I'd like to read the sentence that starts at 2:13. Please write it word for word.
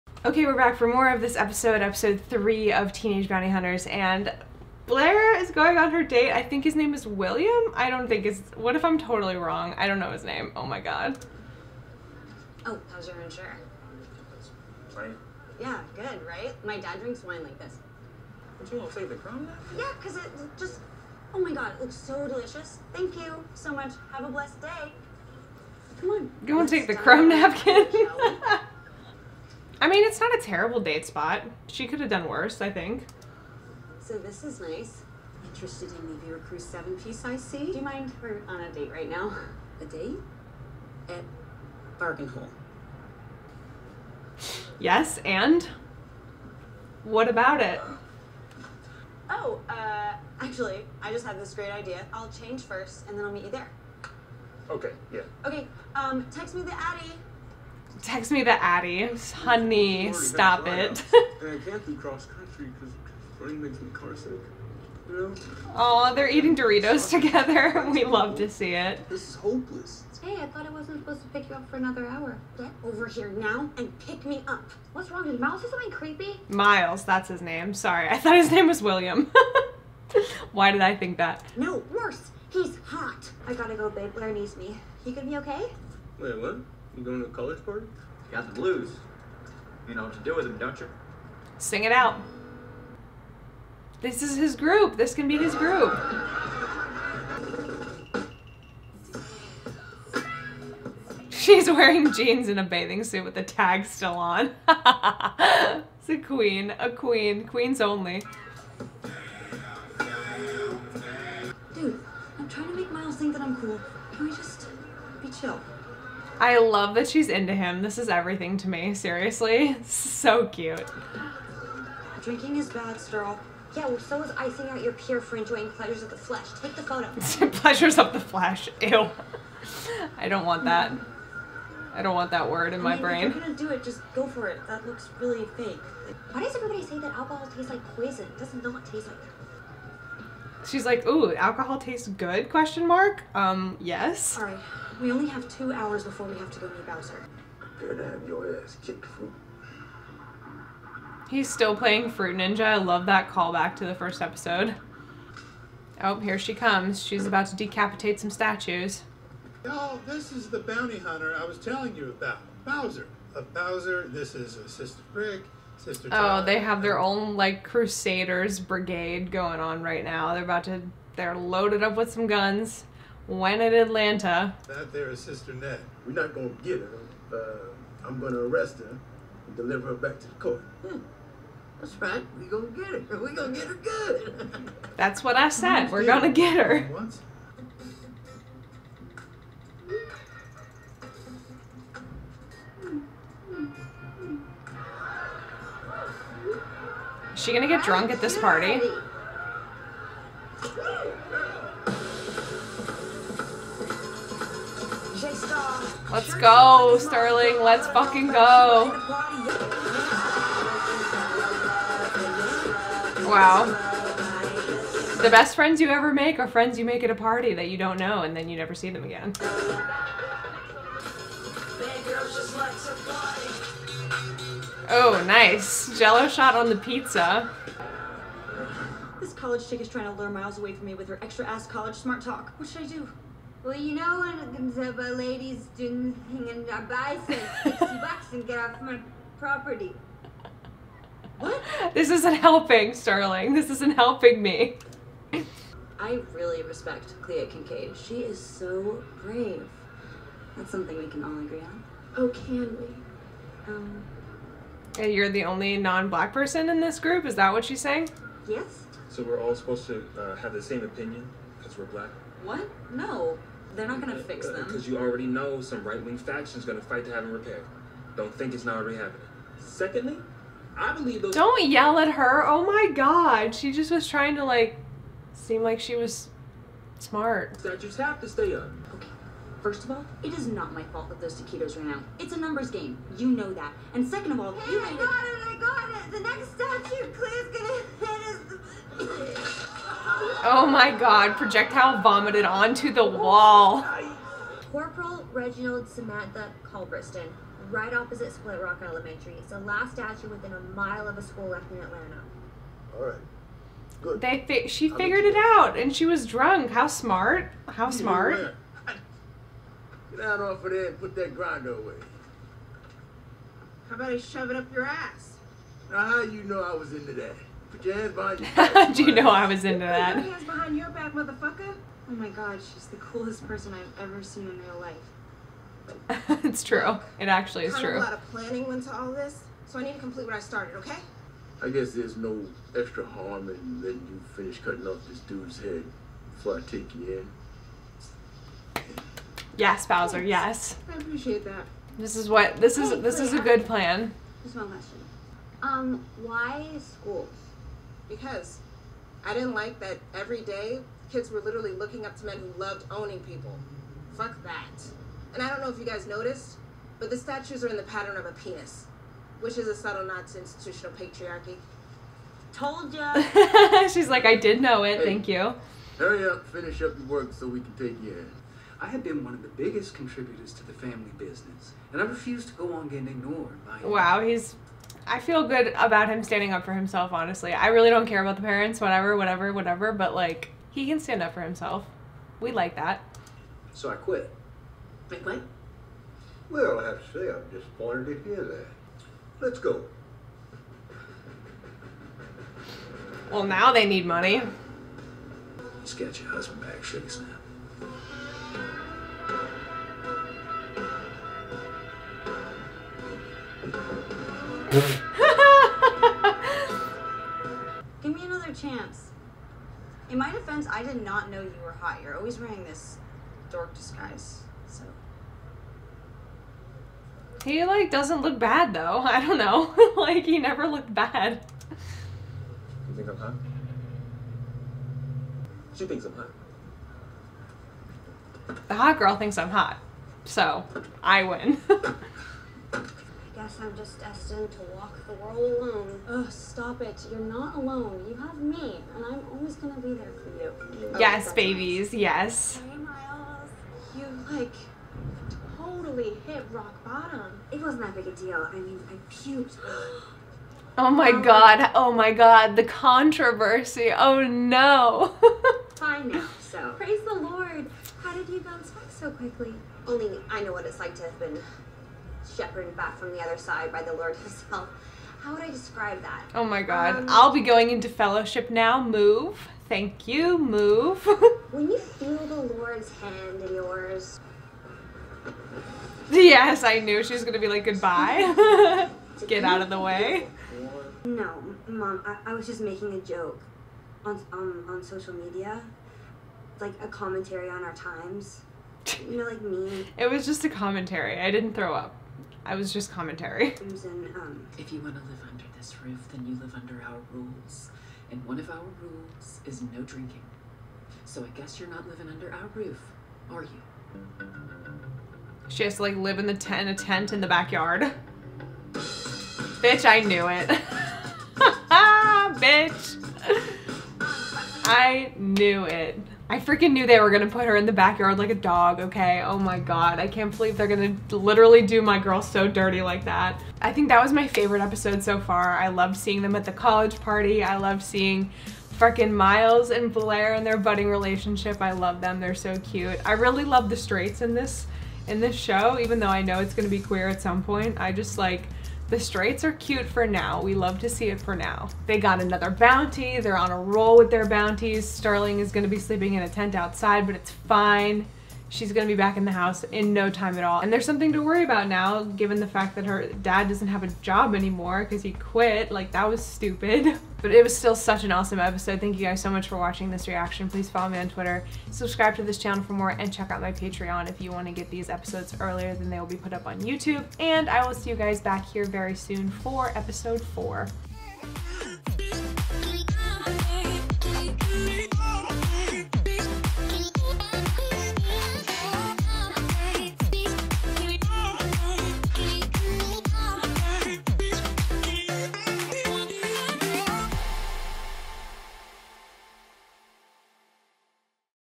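If you're gonna do it, just go for it.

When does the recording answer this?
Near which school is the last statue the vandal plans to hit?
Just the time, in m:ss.
4:58.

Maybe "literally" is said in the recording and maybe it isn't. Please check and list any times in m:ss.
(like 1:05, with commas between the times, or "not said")
5:51, 8:41.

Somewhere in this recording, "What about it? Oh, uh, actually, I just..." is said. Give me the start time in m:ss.
0:47.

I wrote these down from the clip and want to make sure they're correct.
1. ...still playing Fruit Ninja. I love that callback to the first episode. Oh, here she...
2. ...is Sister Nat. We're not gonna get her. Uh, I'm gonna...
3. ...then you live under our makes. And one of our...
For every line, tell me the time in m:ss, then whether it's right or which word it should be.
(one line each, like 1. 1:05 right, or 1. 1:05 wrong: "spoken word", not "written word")
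1. 2:31 right
2. 2:55 right
3. 8:16 wrong: "rules", not "makes".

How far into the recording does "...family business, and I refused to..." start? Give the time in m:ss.
6:10.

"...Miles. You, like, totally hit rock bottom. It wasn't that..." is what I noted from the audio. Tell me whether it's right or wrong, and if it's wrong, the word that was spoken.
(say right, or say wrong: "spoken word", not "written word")
right.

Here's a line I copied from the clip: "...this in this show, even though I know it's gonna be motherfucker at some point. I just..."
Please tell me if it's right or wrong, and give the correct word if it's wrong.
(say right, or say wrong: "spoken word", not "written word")
wrong: "queer", not "motherfucker".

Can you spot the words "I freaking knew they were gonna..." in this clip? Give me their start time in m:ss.
8:36.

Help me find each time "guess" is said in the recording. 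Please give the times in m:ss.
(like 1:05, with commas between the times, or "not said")
5:31, 7:13, 8:21.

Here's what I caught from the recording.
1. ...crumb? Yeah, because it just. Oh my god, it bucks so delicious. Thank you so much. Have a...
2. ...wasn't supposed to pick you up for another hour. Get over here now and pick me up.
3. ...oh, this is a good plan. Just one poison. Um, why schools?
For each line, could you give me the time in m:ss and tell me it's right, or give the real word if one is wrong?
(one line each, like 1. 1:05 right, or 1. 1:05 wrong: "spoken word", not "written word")
1. 0:19 wrong: "looks", not "bucks"
2. 1:10 right
3. 5:42 wrong: "question", not "poison".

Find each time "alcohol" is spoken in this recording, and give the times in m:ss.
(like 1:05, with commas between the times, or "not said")
2:17, 2:21.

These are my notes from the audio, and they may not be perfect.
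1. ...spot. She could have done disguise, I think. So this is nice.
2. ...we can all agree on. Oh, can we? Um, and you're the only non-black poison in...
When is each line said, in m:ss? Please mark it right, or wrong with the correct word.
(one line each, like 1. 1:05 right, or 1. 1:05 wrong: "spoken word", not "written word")
1. 0:31 wrong: "worse", not "disguise"
2. 4:10 wrong: "person", not "poison".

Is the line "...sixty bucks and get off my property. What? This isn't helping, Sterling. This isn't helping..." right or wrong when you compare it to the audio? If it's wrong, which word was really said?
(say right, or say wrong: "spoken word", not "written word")
right.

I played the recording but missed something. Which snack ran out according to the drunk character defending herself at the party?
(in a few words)
taquitos.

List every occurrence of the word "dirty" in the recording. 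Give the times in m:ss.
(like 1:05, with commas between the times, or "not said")
8:42.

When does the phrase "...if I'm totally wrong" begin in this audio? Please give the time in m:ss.
0:08.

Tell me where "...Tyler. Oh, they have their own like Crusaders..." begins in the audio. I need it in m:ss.
2:46.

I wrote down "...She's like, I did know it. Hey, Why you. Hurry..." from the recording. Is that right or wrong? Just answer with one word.
wrong.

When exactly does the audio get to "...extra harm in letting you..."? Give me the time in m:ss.
5:32.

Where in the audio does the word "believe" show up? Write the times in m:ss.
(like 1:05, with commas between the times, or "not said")
4:30, 8:40.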